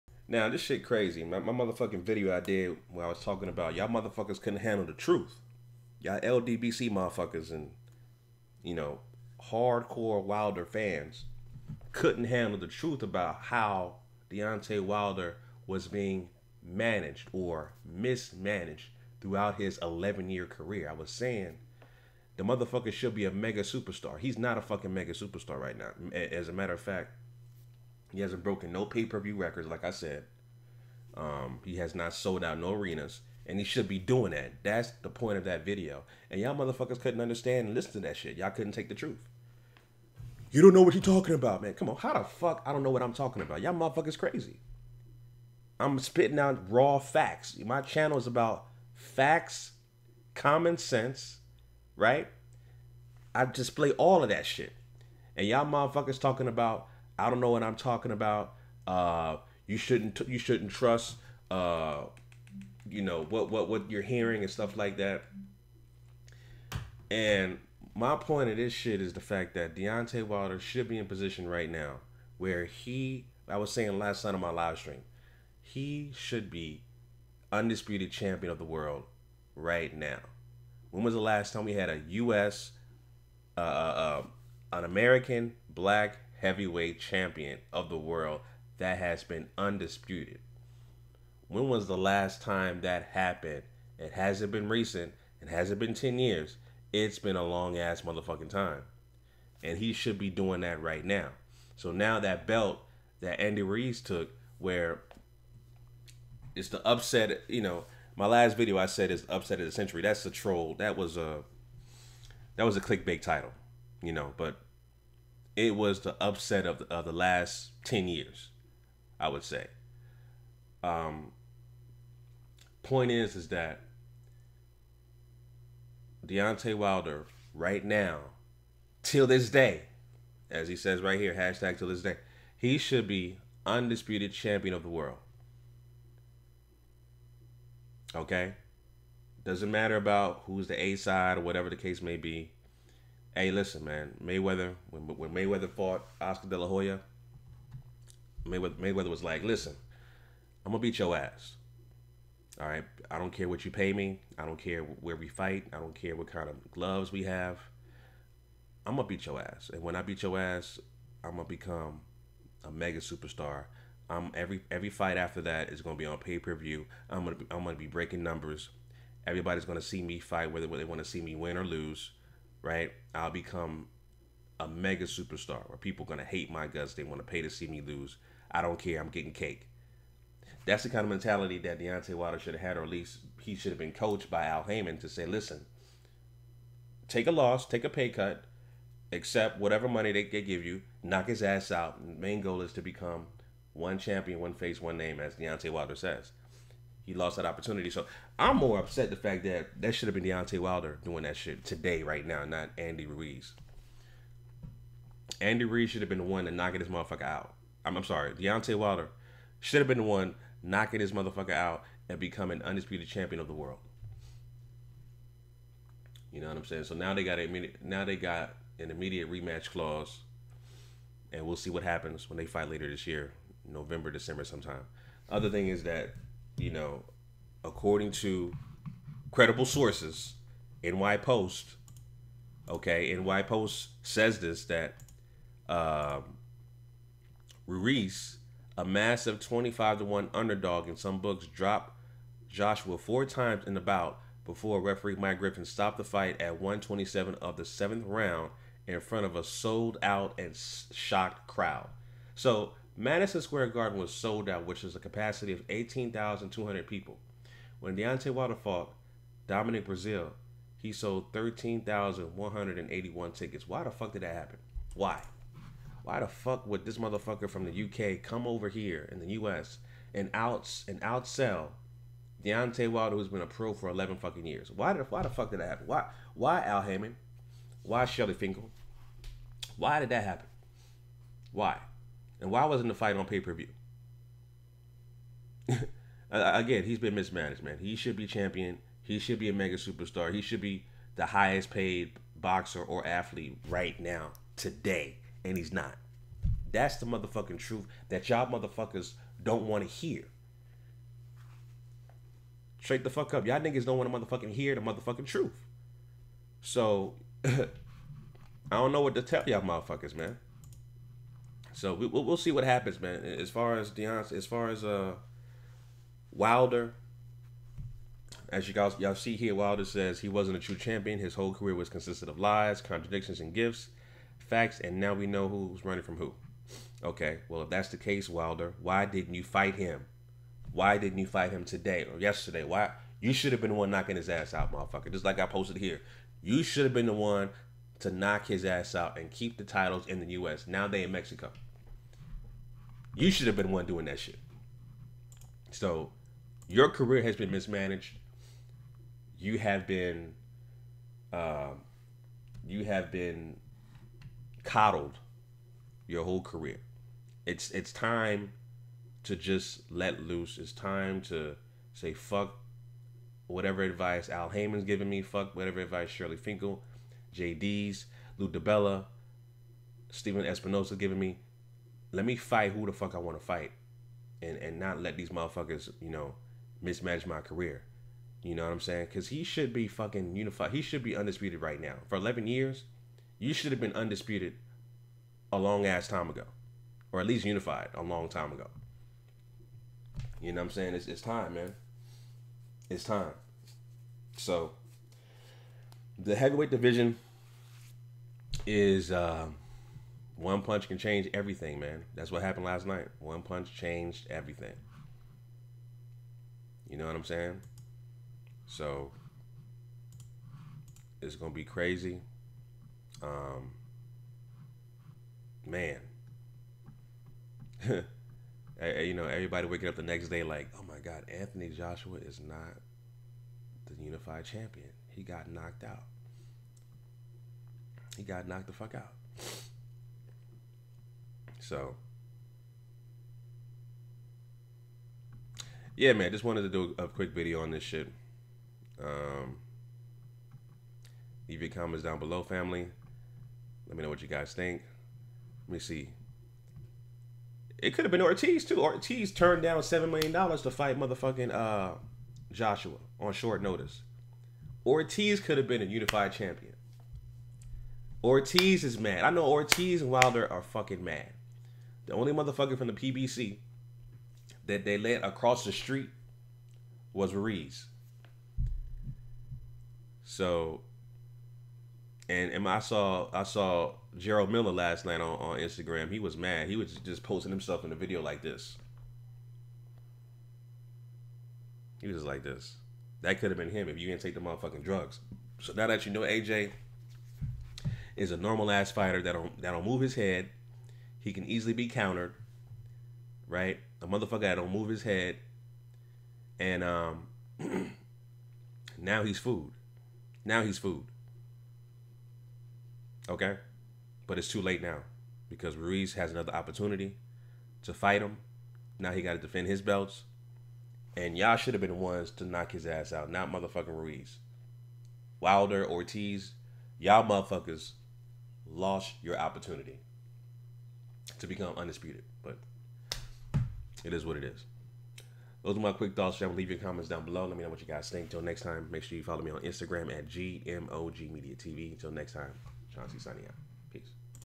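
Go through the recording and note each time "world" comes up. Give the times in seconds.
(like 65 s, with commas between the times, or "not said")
78 s, 87 s, 134 s, 213 s.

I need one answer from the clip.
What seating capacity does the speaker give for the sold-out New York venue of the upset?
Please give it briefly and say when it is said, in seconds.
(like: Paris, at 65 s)
18,200, at 255 s.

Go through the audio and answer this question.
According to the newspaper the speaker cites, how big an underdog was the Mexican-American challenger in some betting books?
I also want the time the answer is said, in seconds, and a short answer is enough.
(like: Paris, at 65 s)
25 to 1, at 239 s.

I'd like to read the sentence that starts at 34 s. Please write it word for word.
That's the point of that video.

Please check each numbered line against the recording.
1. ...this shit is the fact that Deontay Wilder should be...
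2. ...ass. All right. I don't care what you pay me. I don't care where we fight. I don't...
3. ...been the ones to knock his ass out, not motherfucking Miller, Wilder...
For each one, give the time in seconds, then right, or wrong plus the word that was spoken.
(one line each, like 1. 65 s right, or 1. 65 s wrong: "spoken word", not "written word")
1. 68 s right
2. 151 s right
3. 511 s wrong: "Ruiz", not "Miller".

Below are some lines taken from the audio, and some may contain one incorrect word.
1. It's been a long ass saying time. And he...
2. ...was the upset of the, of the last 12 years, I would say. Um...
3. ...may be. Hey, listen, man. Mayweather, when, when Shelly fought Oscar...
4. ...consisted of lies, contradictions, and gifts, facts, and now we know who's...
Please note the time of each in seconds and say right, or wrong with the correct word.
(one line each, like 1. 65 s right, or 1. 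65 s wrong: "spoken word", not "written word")
1. 96 s wrong: "motherfucking", not "saying"
2. 115 s wrong: "10", not "12"
3. 142 s wrong: "Mayweather", not "Shelly"
4. 321 s right.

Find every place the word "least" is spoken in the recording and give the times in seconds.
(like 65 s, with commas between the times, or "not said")
182 s, 387 s.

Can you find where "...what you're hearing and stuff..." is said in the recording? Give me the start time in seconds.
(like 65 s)
63 s.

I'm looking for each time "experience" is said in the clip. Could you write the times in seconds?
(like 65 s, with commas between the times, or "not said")
not said.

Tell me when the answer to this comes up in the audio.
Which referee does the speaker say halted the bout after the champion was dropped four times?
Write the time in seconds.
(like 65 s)
245 s.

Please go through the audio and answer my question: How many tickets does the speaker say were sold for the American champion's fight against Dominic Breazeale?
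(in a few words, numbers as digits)
13,181.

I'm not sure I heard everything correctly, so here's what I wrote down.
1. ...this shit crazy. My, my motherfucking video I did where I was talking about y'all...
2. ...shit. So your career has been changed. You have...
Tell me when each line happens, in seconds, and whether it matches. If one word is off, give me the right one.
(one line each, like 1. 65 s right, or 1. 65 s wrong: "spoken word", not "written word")
1. 0 s right
2. 344 s wrong: "mismanaged", not "changed".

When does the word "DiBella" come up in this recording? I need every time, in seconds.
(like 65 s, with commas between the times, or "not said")
368 s.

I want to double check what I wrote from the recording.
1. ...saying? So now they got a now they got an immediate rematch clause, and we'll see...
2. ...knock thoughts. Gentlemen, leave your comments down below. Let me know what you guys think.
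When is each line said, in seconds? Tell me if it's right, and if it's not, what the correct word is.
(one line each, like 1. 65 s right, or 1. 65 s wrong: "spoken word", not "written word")
1. 216 s right
2. 525 s wrong: "quick", not "knock".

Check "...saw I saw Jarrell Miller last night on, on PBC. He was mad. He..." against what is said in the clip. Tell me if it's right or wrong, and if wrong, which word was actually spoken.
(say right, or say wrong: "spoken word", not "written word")
wrong: "Instagram", not "PBC".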